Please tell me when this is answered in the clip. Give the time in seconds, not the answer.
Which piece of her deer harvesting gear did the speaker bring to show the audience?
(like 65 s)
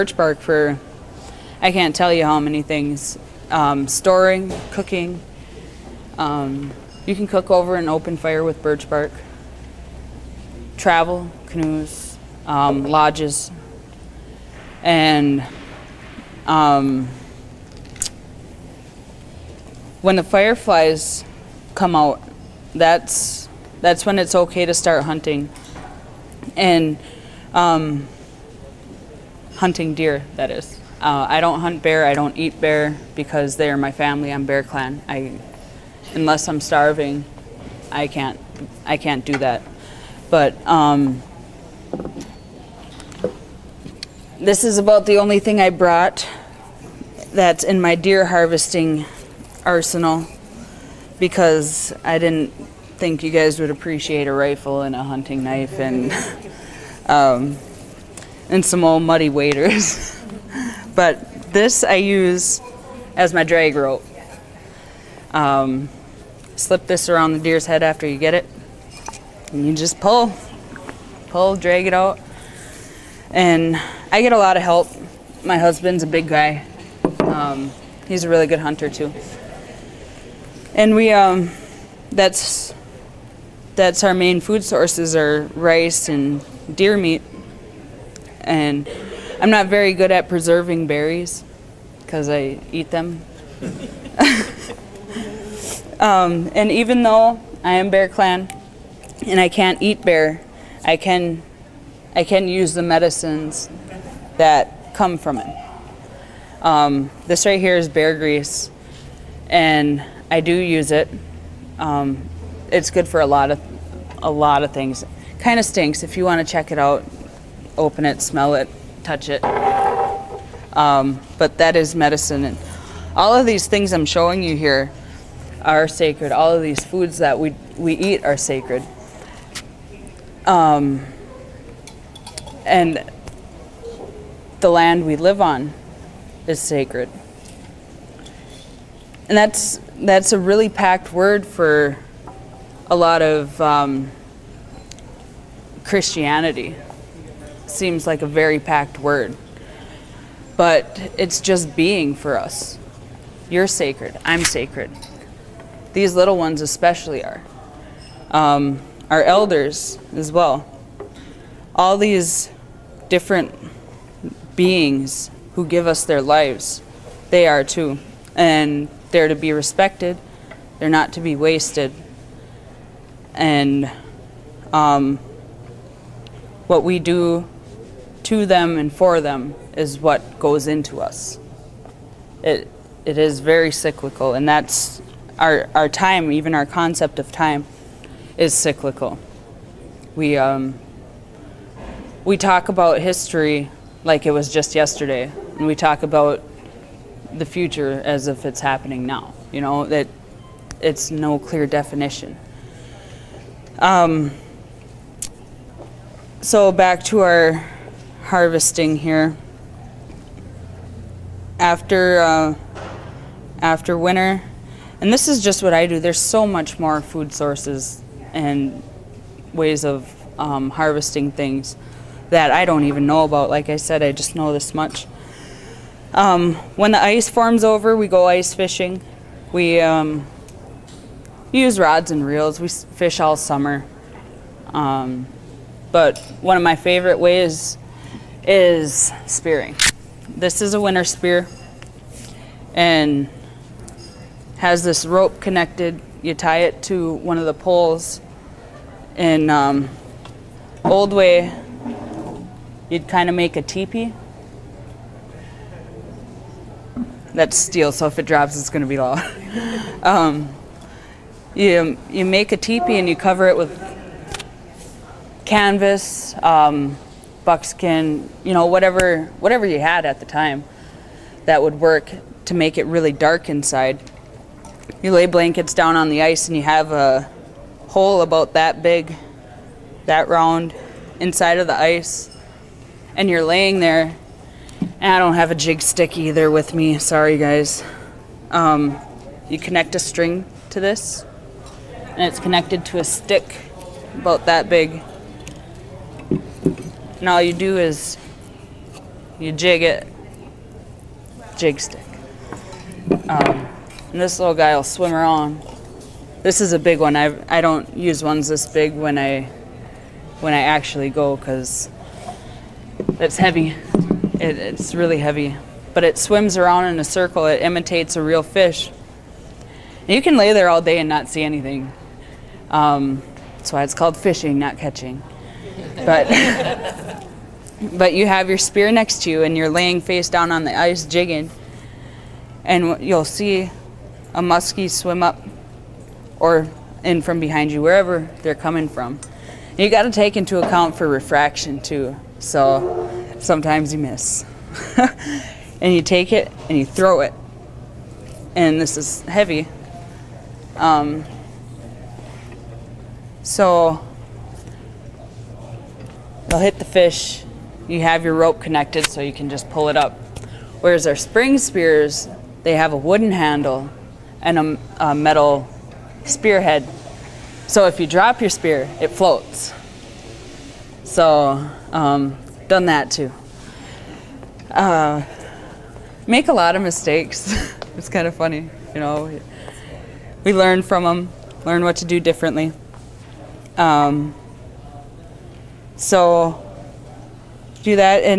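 63 s.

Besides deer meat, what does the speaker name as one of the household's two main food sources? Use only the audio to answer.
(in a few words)
Rice.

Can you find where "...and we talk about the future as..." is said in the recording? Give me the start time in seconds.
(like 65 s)
195 s.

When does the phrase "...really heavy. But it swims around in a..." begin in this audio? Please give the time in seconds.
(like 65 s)
314 s.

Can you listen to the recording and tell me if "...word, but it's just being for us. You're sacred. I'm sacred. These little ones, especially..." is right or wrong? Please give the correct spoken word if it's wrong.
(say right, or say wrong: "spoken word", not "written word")
right.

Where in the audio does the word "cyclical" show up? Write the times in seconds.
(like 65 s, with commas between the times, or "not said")
183 s, 188 s.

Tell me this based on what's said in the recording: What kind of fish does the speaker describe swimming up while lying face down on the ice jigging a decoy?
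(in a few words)
Muskie.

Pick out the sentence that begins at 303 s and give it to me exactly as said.
Um, and this little guy will swim around.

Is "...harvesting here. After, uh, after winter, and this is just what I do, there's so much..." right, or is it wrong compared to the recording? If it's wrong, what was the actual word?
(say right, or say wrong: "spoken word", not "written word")
right.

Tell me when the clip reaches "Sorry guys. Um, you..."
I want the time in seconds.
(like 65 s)
286 s.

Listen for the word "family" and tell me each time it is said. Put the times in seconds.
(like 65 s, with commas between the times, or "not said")
33 s.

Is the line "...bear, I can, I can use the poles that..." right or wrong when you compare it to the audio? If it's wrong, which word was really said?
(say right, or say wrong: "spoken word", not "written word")
wrong: "medicines", not "poles".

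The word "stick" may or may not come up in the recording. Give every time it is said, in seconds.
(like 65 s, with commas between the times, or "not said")
285 s, 293 s, 301 s.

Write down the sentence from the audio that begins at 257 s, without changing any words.
That's steel, so if it drops, it's going to be loud.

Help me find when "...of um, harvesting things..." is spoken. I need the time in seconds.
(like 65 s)
219 s.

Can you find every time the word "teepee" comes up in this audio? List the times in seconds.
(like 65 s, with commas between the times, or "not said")
253 s, 262 s.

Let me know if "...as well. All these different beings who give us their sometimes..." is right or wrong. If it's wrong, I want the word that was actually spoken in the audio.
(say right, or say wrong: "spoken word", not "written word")
wrong: "lives", not "sometimes".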